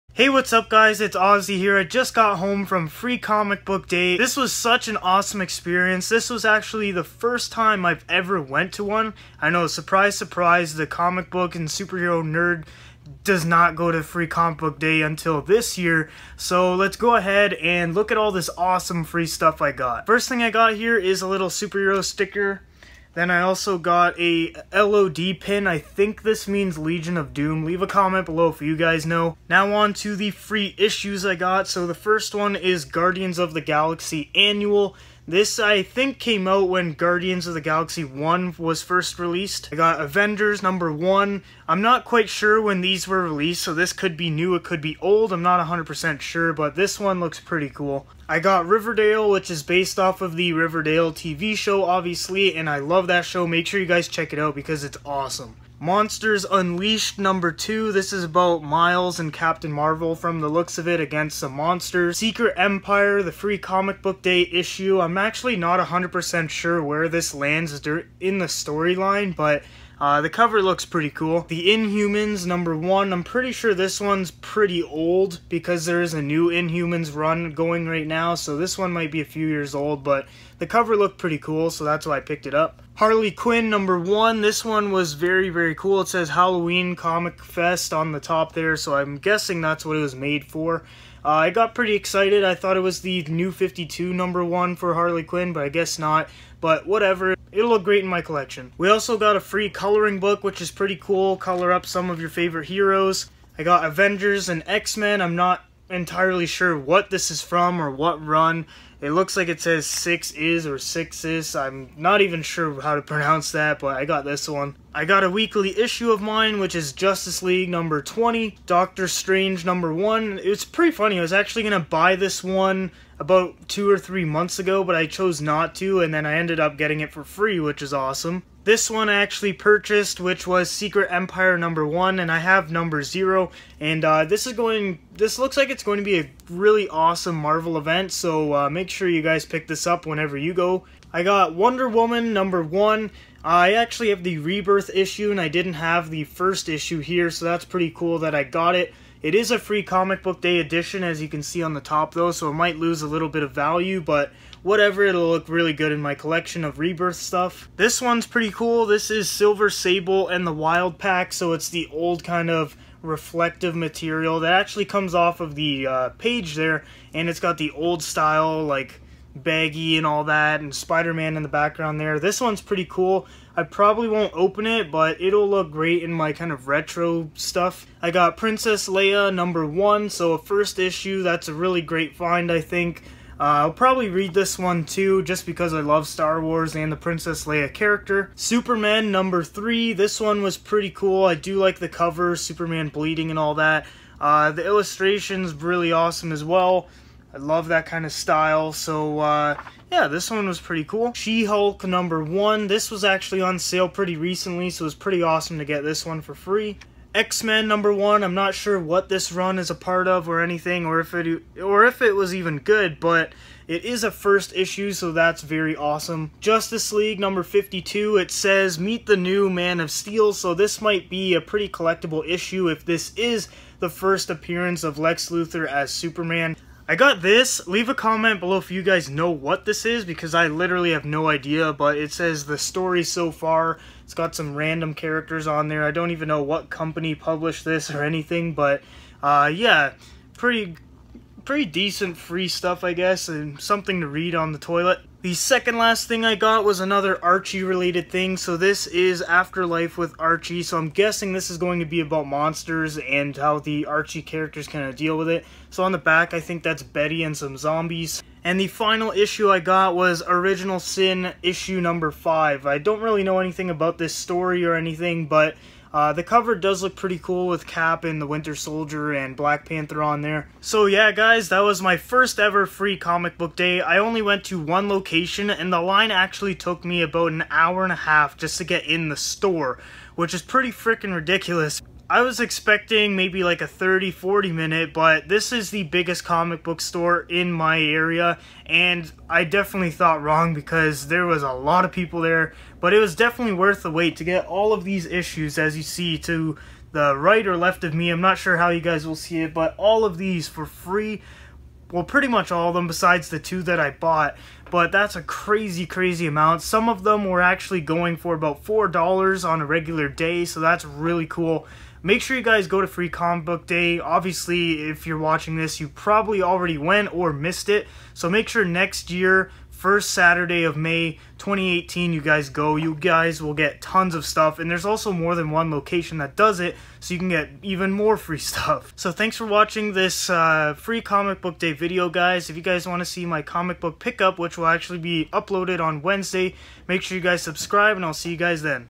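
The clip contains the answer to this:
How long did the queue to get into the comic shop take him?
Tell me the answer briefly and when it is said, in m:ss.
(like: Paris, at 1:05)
an hour and a half, at 4:37.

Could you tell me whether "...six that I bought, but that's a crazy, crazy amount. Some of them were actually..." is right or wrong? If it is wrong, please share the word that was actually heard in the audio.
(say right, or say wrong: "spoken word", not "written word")
wrong: "two", not "six".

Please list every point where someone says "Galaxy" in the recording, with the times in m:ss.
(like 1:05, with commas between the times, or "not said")
0:33, 0:37.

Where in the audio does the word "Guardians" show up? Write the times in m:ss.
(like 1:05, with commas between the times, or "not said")
0:32, 0:36.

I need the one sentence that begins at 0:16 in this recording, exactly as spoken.
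So let's go ahead and look at all this awesome free stuff I got.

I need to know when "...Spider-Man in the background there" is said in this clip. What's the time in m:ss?
2:50.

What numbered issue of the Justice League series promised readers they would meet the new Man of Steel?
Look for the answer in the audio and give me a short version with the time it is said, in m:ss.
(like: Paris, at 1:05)
52, at 3:36.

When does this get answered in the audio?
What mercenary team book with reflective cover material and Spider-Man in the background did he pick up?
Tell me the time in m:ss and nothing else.
2:39.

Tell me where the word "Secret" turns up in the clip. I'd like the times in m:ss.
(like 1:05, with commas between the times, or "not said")
1:02, 2:10.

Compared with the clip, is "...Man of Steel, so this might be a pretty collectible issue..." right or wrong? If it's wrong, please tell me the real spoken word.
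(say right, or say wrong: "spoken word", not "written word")
right.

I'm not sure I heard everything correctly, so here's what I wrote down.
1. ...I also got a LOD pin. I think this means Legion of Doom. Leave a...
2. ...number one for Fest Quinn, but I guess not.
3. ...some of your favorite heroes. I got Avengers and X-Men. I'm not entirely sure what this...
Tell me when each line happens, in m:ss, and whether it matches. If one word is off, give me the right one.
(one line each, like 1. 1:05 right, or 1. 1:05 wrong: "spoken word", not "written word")
1. 0:23 right
2. 1:34 wrong: "Harley", not "Fest"
3. 1:41 right.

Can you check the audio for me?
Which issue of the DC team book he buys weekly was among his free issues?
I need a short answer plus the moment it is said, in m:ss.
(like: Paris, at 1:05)
Justice League #20, at 1:56.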